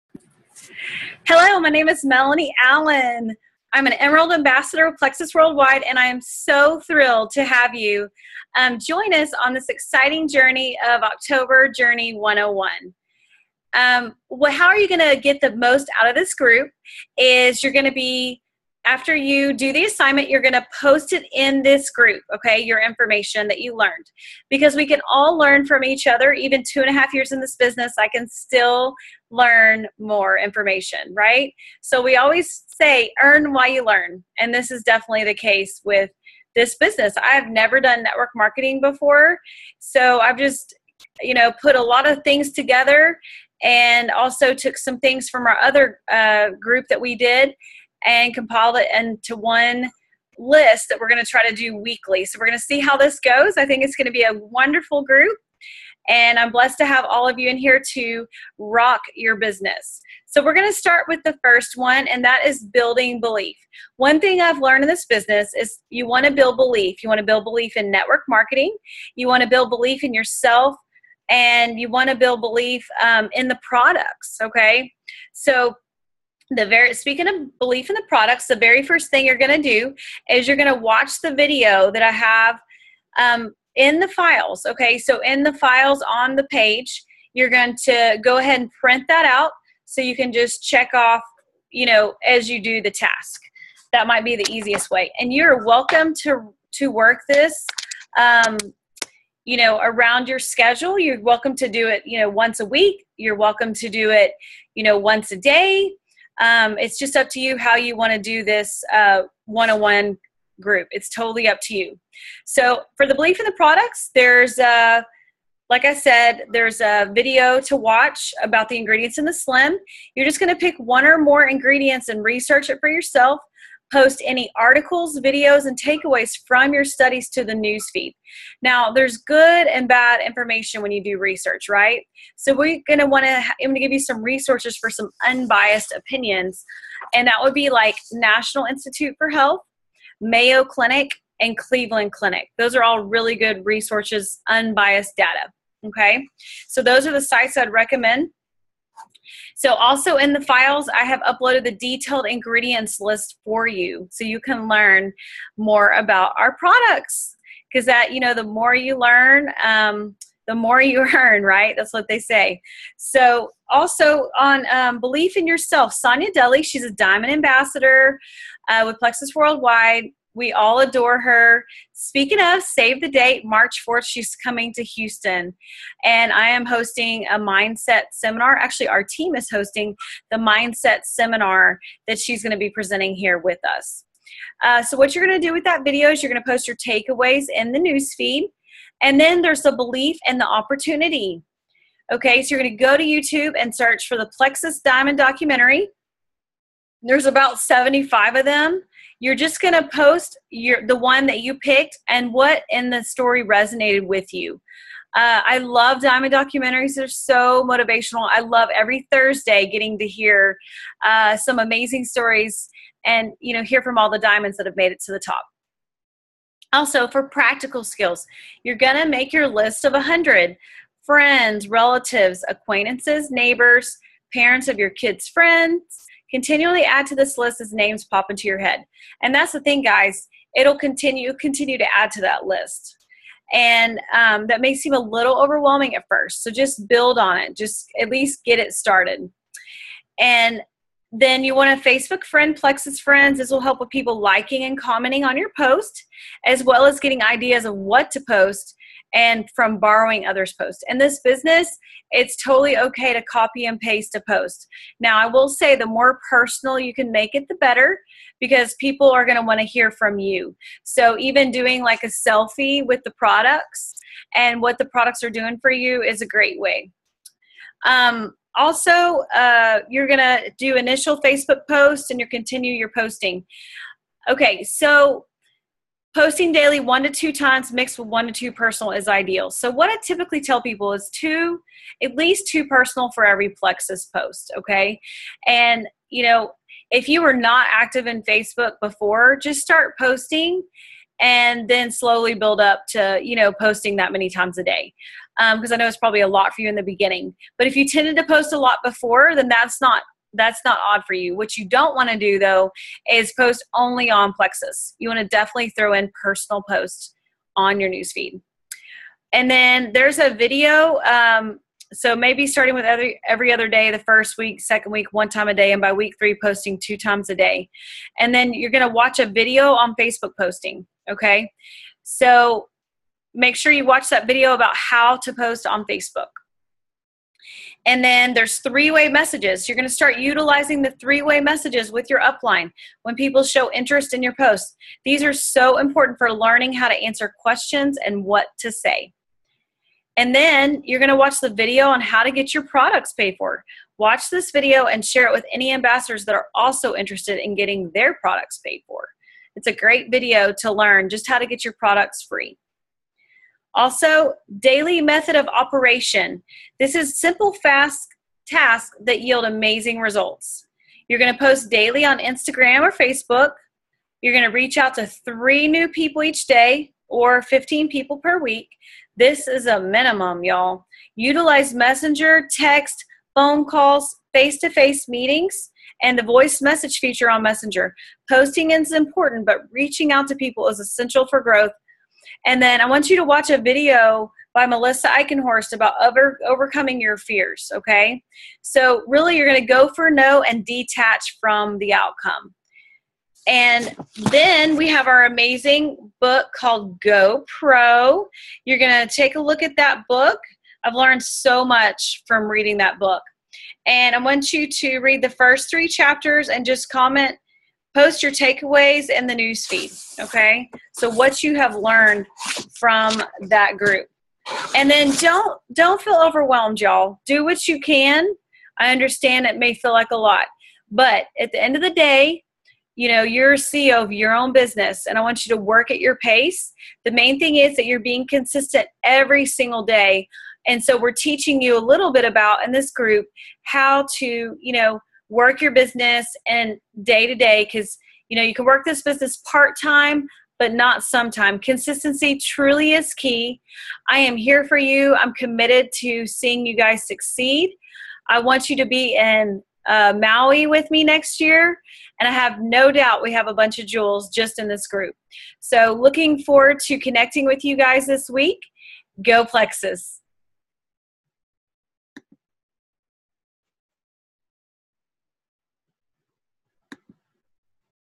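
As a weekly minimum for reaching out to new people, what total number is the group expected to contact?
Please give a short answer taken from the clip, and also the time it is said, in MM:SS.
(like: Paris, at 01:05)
15, at 06:07.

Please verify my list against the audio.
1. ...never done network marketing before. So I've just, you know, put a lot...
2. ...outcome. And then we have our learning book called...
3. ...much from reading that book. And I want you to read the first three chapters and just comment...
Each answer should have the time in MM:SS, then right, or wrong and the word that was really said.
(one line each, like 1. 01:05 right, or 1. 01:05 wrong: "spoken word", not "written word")
1. 00:37 right
2. 06:31 wrong: "amazing", not "learning"
3. 06:41 right.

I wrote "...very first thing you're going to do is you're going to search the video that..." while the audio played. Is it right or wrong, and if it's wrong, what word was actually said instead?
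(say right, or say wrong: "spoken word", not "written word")
wrong: "watch", not "search".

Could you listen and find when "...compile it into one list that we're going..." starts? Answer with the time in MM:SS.
00:48.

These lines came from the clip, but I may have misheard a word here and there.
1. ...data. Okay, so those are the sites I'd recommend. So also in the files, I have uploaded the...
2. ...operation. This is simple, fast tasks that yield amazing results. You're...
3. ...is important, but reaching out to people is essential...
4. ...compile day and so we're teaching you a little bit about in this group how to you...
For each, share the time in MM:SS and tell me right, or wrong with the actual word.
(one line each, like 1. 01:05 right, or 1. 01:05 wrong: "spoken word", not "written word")
1. 02:25 right
2. 05:55 right
3. 06:18 right
4. 07:09 wrong: "single", not "compile".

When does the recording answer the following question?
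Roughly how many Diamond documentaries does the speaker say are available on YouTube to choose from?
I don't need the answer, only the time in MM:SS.
03:17.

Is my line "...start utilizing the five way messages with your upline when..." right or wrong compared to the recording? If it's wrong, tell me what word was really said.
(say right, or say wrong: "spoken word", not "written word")
wrong: "three", not "five".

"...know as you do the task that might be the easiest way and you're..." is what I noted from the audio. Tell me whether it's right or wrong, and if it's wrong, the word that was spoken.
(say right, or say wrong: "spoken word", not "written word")
right.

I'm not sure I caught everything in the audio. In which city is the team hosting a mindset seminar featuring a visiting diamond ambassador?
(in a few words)
Houston.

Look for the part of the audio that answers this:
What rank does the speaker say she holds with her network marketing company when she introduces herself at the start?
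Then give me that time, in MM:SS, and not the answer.
00:03.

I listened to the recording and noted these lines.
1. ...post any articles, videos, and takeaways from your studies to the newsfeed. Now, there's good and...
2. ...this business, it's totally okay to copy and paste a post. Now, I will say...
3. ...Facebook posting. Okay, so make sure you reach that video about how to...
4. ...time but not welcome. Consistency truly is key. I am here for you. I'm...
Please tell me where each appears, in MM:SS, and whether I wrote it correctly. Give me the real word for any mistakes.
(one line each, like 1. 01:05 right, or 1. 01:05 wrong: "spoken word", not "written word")
1. 02:03 right
2. 04:10 right
3. 05:19 wrong: "watch", not "reach"
4. 07:19 wrong: "sometime", not "welcome".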